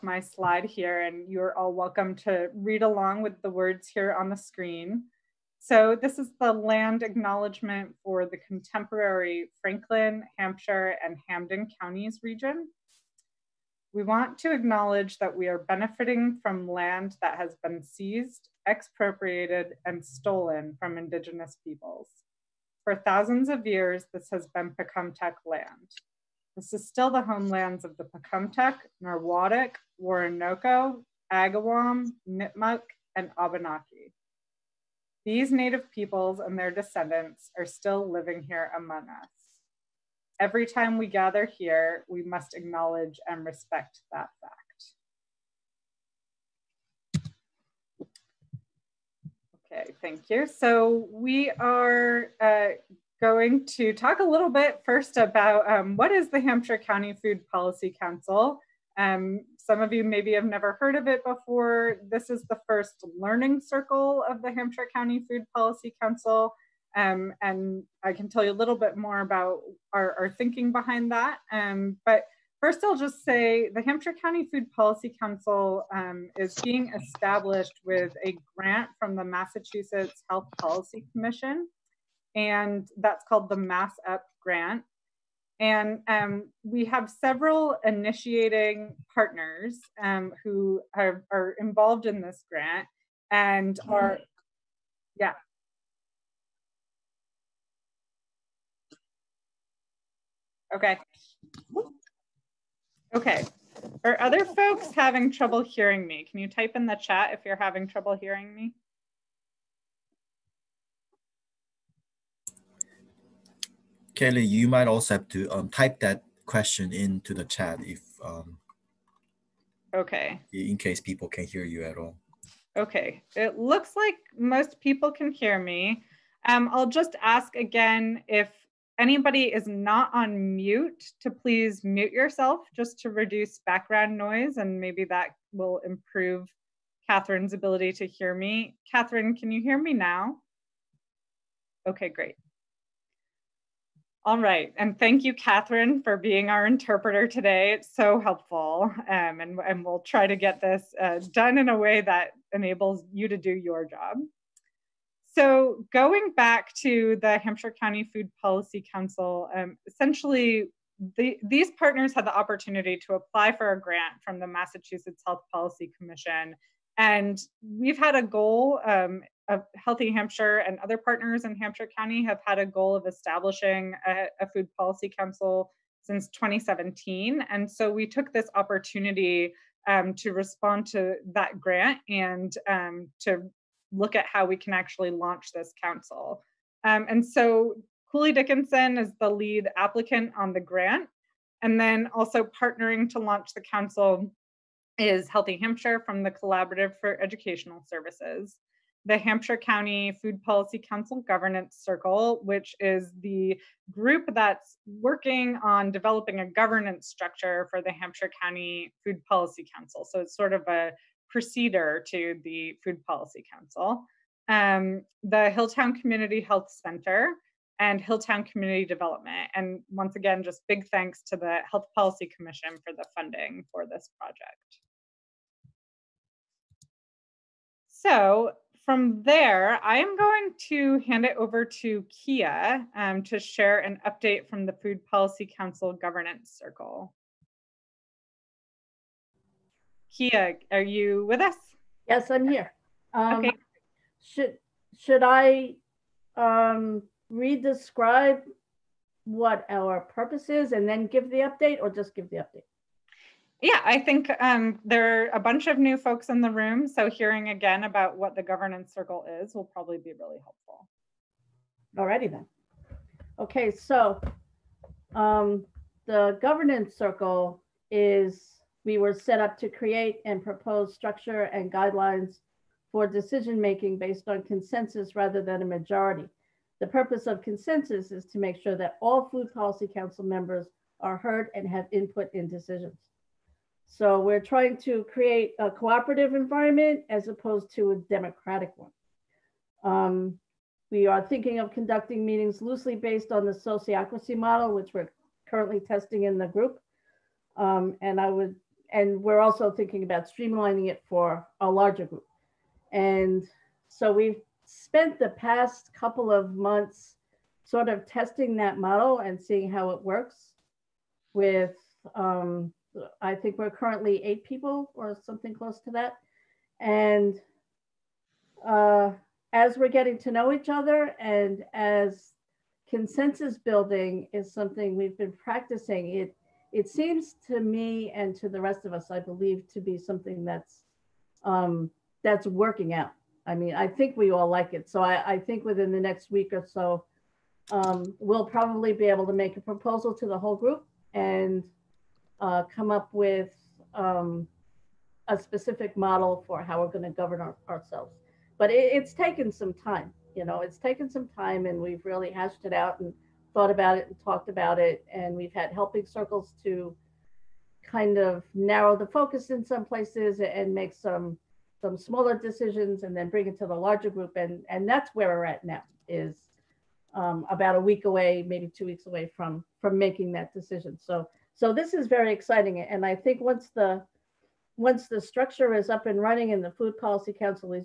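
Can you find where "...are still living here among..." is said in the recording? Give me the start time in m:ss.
0:37.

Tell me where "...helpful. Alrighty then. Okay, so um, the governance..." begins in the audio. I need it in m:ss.
4:20.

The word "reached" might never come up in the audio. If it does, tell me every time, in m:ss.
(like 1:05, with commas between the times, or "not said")
not said.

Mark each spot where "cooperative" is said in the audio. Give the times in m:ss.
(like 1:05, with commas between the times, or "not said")
4:45.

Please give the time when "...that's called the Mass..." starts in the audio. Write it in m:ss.
1:22.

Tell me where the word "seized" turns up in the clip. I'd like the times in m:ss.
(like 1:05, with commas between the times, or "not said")
0:17.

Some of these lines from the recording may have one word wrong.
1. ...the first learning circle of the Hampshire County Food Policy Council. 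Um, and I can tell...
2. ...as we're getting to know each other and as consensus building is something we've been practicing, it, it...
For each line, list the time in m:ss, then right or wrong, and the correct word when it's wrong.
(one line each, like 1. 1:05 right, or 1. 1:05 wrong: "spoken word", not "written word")
1. 1:02 right
2. 5:19 right.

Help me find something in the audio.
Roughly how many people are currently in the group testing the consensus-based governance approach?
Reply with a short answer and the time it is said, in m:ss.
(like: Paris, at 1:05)
8, at 5:14.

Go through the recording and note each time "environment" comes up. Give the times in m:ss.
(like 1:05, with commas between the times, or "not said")
4:46.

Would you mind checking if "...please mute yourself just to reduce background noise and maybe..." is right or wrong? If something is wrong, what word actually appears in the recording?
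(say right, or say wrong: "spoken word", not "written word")
right.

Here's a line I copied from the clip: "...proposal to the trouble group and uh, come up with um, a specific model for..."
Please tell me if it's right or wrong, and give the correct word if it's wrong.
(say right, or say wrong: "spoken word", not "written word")
wrong: "whole", not "trouble".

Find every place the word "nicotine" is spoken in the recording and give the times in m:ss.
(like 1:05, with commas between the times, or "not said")
not said.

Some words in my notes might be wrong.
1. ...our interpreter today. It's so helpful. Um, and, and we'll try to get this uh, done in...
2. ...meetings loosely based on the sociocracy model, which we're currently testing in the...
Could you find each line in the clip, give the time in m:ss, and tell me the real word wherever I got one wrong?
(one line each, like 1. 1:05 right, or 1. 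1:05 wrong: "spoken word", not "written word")
1. 2:26 right
2. 4:52 right.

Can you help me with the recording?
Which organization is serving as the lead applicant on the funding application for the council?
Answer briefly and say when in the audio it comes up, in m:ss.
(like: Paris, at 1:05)
Cooley Dickinson, at 3:08.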